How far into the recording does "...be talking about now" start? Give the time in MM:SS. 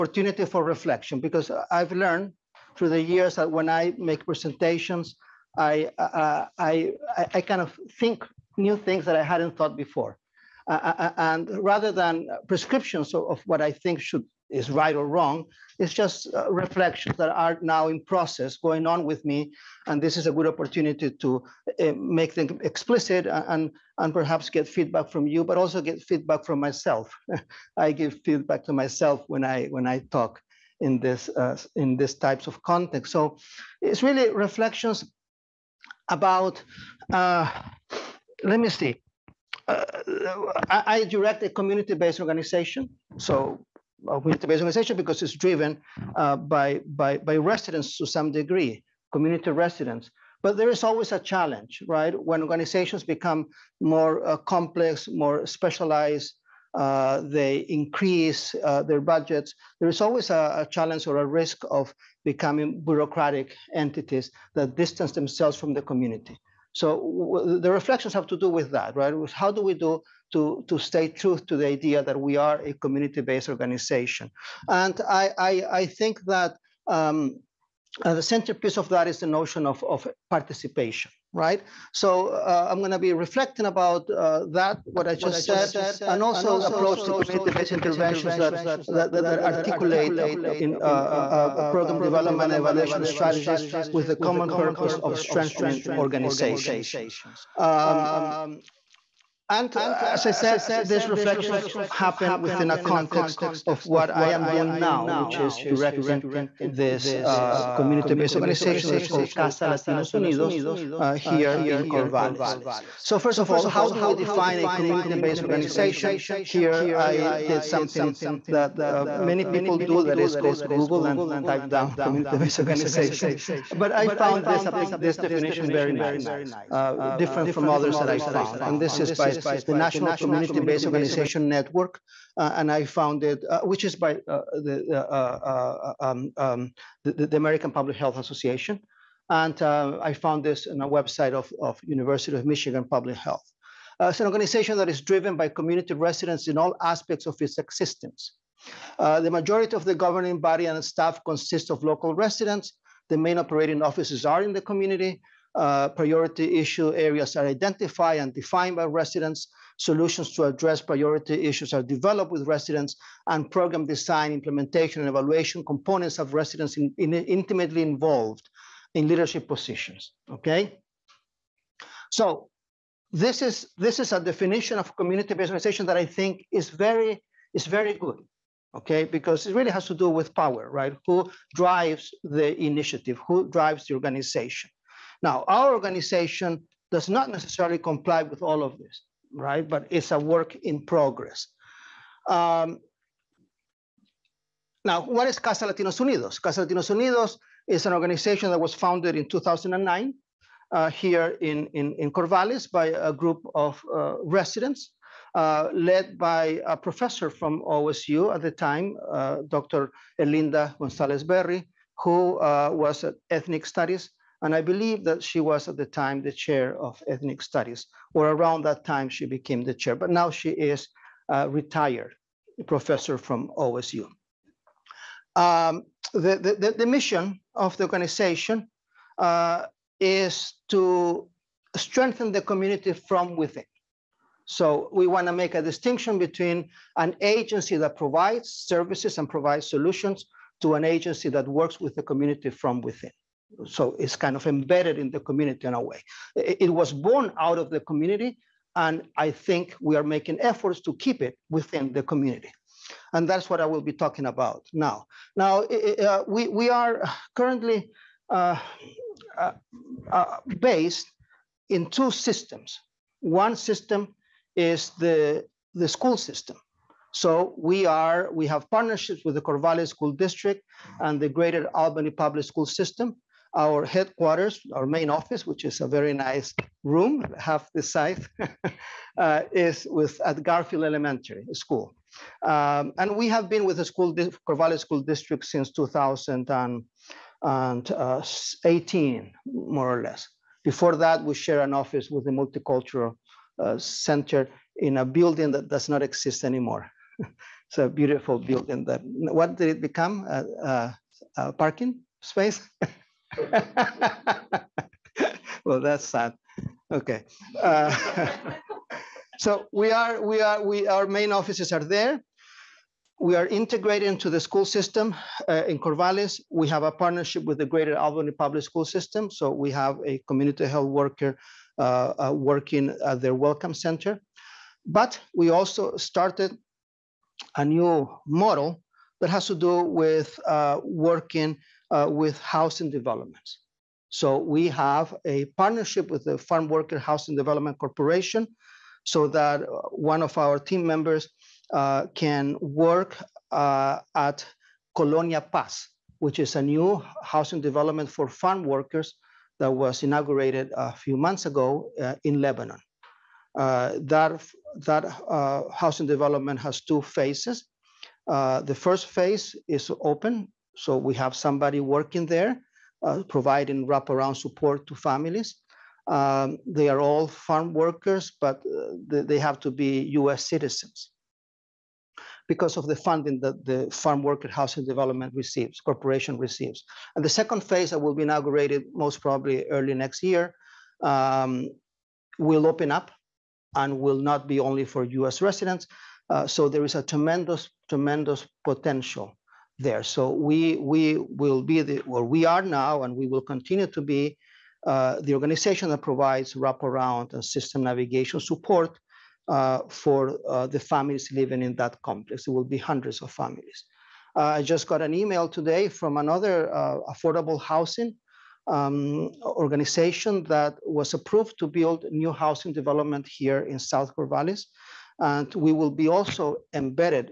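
04:13.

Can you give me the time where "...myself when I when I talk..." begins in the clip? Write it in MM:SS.
00:28.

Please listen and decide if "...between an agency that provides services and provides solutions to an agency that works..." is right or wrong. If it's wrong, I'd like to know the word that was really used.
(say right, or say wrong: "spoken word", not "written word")
right.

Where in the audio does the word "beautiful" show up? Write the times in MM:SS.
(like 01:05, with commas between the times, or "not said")
04:57.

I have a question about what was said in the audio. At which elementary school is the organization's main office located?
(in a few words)
Garfield Elementary School.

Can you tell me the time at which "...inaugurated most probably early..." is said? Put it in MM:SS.
06:18.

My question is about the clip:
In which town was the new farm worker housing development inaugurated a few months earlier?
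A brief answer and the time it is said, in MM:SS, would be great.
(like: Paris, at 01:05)
Lebanon, at 05:52.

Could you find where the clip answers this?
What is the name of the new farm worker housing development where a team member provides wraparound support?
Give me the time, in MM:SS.
05:44.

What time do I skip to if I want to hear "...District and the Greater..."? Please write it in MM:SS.
04:30.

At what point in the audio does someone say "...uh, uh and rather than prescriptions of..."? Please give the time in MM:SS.
00:10.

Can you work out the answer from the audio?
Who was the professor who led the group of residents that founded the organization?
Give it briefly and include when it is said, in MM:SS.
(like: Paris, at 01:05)
Dr. Erlinda Gonzales Berry, at 03:29.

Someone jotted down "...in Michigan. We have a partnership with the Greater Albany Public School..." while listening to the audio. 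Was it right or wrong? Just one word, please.
wrong.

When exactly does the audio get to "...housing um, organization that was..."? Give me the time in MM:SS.
06:47.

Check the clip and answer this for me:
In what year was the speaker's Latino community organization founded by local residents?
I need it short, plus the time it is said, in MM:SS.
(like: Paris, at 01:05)
2009, at 03:19.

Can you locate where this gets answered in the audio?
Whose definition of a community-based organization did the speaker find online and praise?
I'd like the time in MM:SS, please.
02:09.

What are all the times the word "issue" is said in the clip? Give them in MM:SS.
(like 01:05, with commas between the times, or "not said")
02:36, 02:41.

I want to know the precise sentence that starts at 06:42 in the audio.
It will be hundreds of families.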